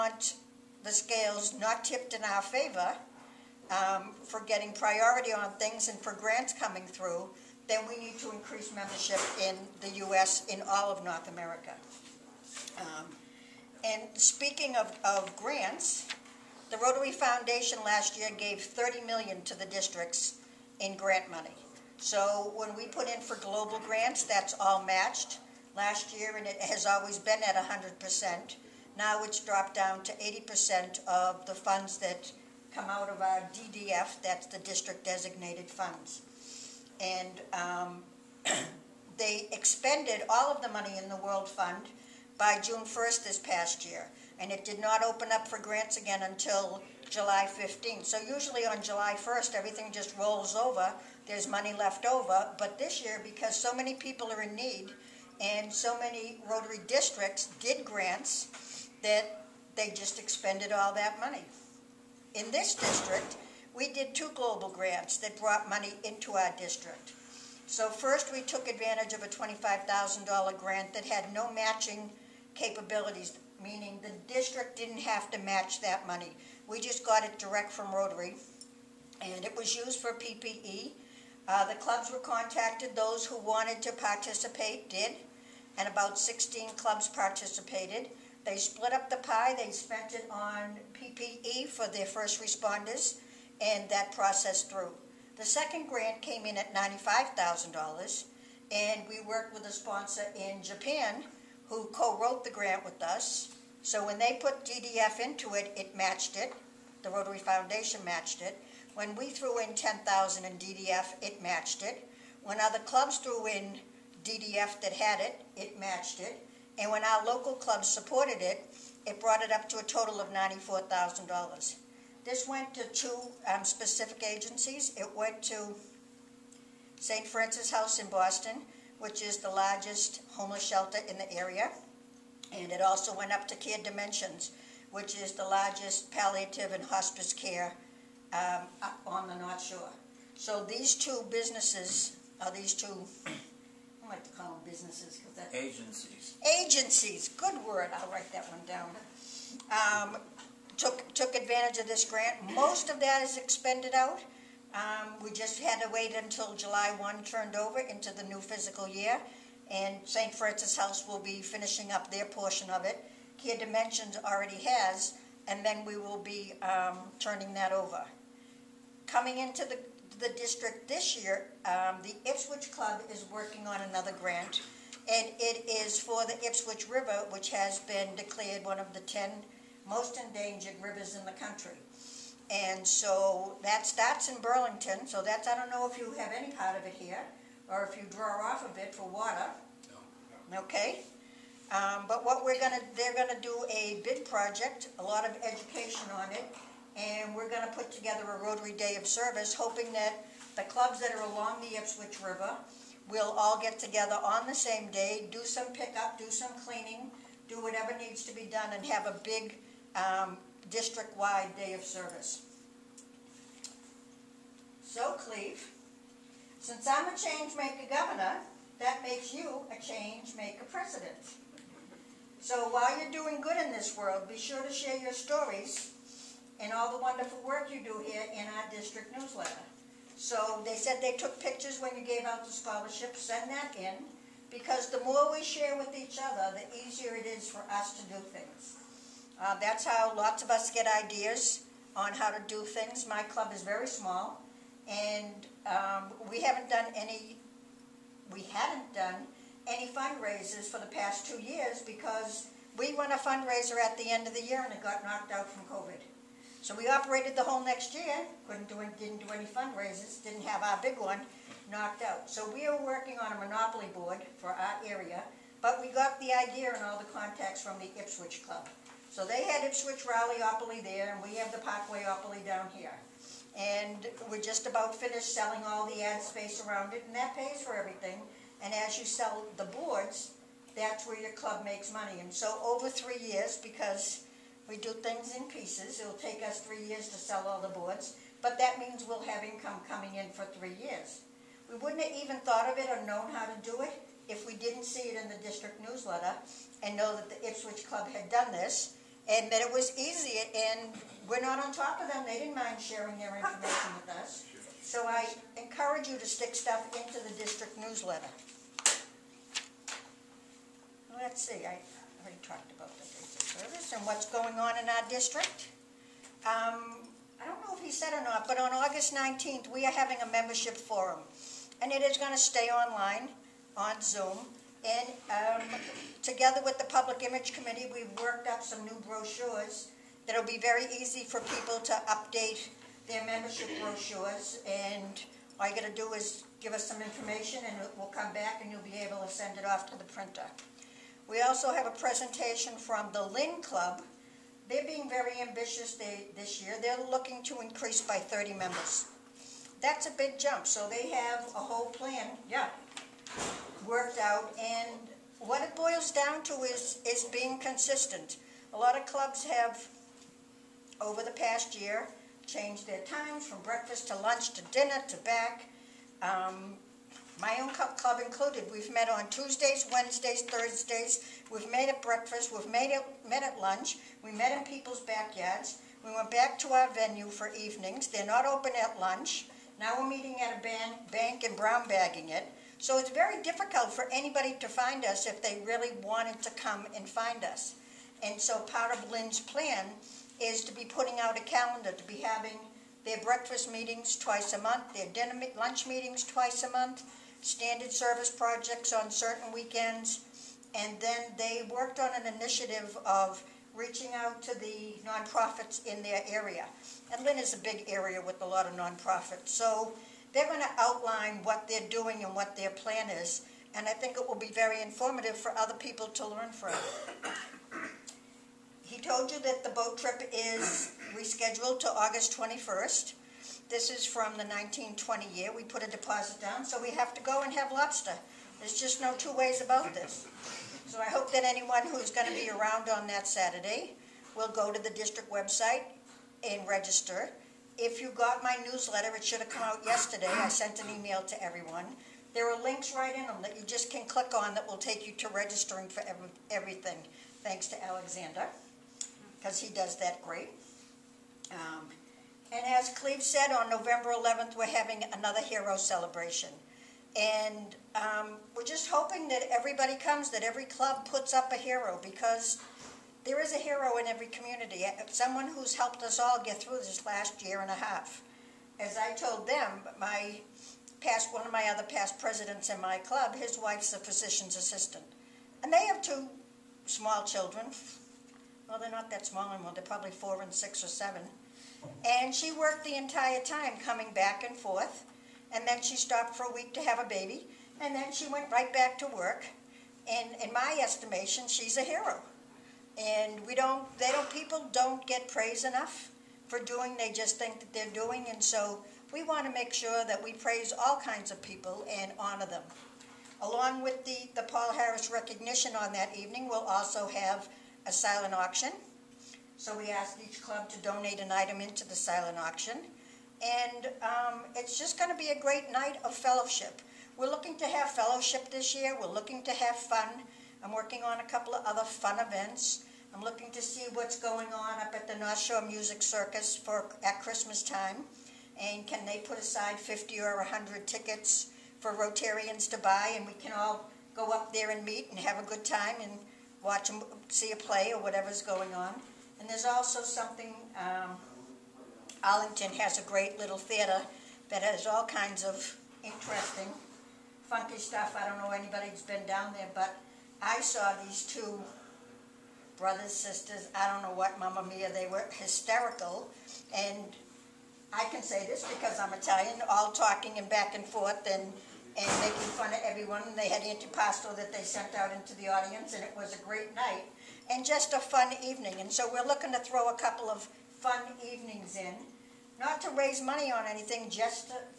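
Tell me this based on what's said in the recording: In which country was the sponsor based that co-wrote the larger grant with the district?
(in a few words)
Japan.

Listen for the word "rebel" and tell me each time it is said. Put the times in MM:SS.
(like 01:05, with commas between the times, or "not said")
not said.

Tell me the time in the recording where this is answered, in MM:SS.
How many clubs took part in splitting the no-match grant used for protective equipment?
01:26.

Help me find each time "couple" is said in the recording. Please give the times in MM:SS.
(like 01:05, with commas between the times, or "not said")
08:41, 09:29.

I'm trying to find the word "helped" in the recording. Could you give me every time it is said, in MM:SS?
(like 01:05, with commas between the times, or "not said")
07:45.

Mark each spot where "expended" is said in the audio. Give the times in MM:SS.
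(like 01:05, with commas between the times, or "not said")
00:39, 01:00, 02:33.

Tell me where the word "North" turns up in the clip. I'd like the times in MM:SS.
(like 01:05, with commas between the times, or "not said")
00:11, 02:19, 08:45.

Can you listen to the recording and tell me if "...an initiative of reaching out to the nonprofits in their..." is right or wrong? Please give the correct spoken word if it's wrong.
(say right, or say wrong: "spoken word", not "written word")
right.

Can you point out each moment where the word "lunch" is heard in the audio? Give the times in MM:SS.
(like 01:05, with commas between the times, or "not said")
06:04, 06:13, 06:19, 06:35.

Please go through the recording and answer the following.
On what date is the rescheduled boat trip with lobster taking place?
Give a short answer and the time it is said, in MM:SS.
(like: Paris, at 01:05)
August 21st, at 07:01.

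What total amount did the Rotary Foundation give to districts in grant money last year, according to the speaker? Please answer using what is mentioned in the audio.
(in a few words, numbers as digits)
30 million.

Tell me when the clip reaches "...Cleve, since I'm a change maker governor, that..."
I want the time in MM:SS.
03:35.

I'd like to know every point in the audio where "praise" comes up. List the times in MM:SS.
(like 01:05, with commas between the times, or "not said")
08:15, 08:20.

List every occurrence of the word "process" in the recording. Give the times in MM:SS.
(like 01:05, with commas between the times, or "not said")
01:34.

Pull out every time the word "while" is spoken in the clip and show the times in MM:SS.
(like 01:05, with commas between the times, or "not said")
03:42.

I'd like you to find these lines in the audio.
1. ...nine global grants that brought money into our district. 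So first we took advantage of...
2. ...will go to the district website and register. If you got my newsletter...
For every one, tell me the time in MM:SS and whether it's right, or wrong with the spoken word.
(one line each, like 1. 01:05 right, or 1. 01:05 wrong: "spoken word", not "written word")
1. 01:04 wrong: "two", not "nine"
2. 07:14 right.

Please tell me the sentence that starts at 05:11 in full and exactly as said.
Let's see, I already talked about Service and what's going on in our district.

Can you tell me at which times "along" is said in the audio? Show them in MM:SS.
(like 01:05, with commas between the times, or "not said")
03:21, 08:23.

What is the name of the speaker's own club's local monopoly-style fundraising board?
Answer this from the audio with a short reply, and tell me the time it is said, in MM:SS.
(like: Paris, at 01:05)
Parkwayopoly, at 04:31.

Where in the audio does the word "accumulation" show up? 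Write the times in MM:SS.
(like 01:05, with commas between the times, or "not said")
not said.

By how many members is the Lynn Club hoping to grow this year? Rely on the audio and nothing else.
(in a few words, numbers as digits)
30.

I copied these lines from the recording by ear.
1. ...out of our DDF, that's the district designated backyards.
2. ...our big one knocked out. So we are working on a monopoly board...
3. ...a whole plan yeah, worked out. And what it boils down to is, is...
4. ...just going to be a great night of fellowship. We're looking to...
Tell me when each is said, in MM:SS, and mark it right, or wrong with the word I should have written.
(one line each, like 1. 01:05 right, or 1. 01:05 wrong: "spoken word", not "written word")
1. 00:32 wrong: "funds", not "backyards"
2. 04:20 right
3. 05:51 right
4. 08:34 right.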